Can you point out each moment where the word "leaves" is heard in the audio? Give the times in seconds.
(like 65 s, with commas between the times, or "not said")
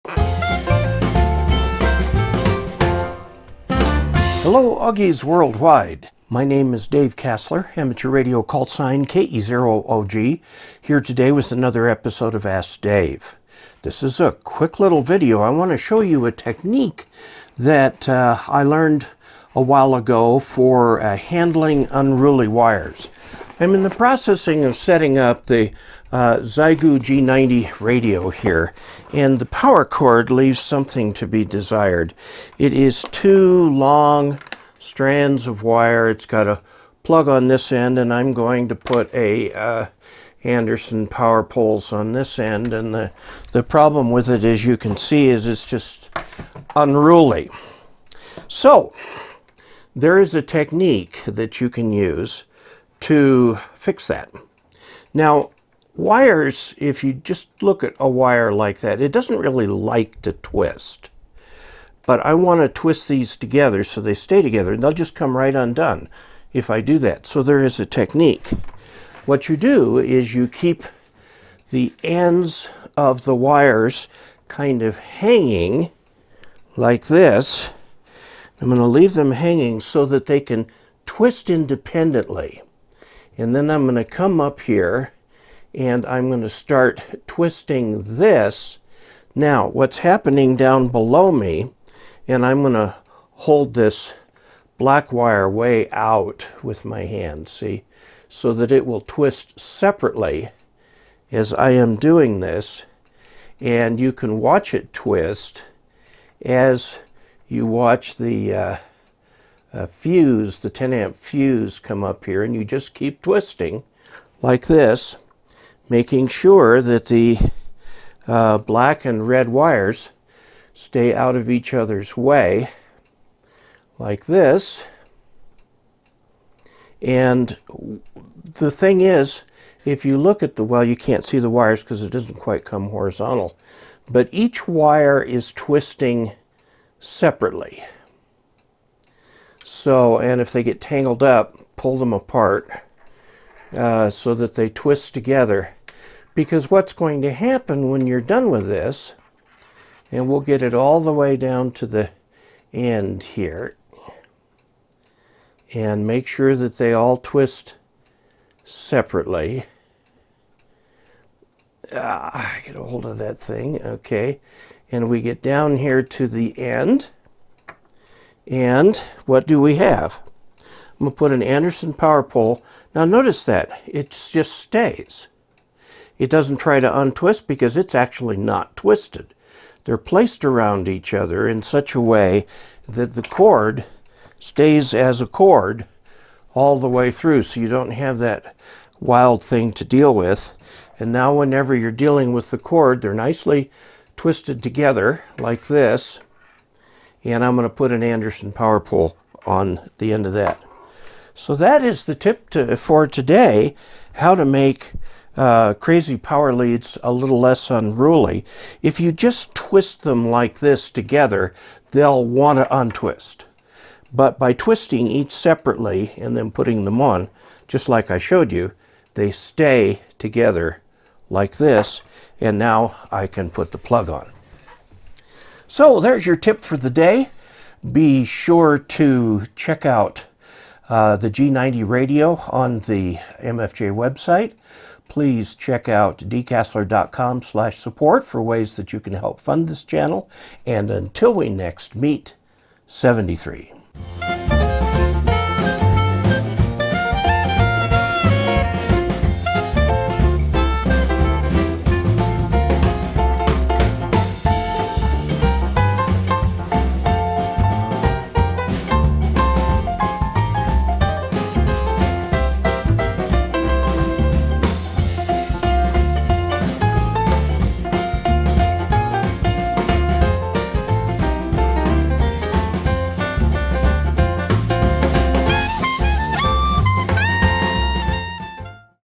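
30 s, 78 s.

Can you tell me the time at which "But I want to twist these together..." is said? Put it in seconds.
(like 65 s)
62 s.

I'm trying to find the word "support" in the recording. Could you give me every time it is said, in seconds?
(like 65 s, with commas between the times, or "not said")
237 s.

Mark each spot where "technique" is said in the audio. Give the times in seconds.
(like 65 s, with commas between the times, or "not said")
16 s, 50 s, 67 s.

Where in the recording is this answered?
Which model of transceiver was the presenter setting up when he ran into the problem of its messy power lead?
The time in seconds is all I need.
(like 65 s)
26 s.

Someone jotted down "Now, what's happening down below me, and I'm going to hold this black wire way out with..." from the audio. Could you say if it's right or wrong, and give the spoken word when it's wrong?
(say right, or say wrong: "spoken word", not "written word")
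right.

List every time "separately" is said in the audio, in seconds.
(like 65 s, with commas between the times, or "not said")
99 s, 136 s, 158 s, 215 s.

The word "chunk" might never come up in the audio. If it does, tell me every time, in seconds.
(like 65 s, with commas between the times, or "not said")
not said.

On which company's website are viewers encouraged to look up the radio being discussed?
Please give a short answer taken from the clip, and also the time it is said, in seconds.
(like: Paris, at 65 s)
MFJ, at 233 s.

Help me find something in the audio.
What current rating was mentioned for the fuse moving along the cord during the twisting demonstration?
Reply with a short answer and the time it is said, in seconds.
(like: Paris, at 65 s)
10 amp, at 110 s.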